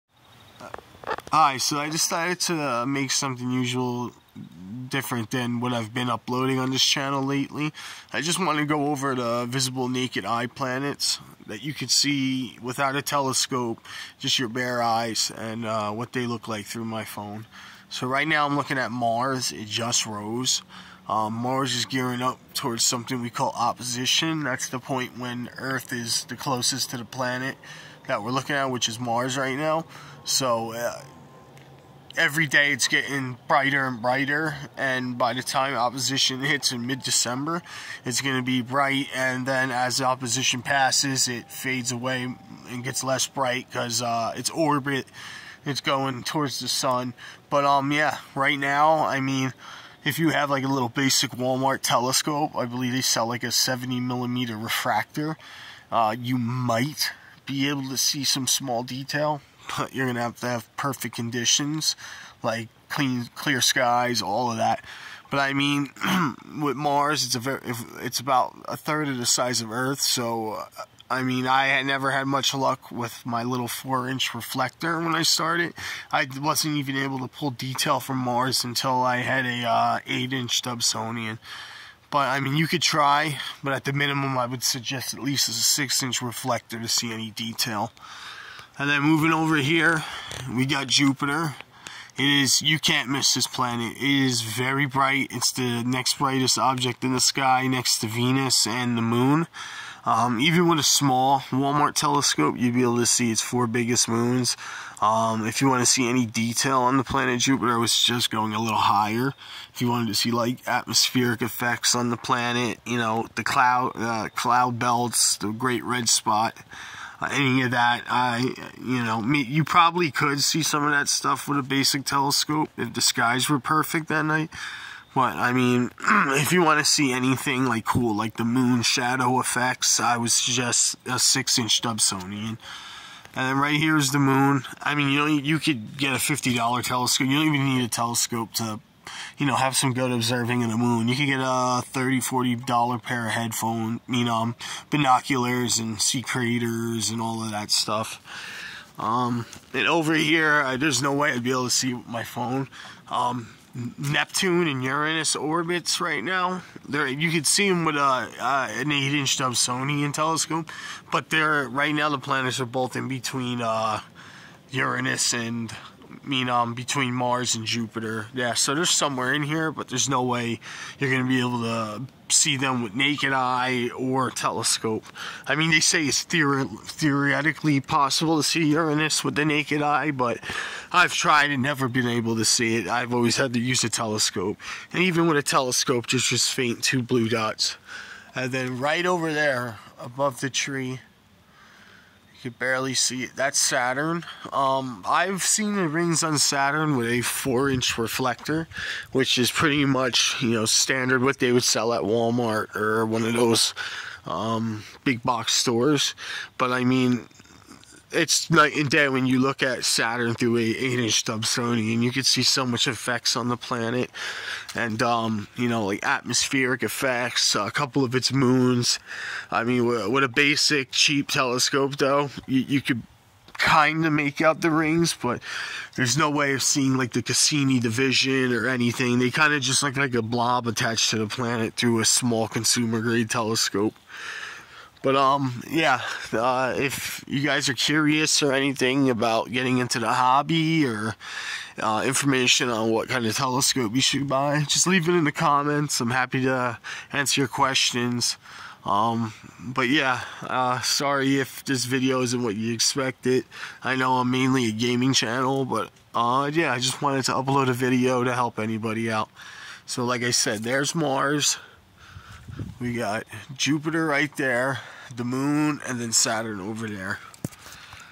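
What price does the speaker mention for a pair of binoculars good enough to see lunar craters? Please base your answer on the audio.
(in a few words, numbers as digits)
30 dollars.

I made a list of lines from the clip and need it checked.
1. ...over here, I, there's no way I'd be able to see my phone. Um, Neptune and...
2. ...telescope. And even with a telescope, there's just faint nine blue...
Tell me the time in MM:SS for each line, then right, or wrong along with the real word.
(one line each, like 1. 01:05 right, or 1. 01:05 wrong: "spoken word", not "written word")
1. 02:29 right
2. 03:03 wrong: "two", not "nine".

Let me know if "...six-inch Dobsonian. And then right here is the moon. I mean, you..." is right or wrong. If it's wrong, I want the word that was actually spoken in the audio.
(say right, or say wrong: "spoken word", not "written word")
right.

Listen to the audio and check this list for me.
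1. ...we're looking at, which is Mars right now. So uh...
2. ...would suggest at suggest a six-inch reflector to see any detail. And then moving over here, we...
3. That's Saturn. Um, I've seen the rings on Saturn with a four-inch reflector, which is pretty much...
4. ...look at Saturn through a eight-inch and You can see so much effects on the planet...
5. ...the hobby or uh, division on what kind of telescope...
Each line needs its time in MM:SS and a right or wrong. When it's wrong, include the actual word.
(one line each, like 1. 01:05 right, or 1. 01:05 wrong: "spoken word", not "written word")
1. 00:28 right
2. 01:24 wrong: "least", not "suggest"
3. 03:13 right
4. 03:29 right
5. 03:59 wrong: "information", not "division".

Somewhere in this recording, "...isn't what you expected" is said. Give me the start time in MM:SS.
04:12.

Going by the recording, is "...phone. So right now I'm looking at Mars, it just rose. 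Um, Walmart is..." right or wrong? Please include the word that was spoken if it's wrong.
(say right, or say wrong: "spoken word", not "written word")
wrong: "Mars", not "Walmart".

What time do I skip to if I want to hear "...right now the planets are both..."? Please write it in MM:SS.
02:41.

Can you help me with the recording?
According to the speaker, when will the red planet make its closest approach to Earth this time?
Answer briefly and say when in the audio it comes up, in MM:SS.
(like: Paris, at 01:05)
mid-December, at 00:36.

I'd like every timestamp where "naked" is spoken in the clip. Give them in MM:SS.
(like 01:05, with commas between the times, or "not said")
00:09, 02:52, 02:59.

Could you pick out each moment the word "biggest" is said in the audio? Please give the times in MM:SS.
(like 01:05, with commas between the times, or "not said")
01:43.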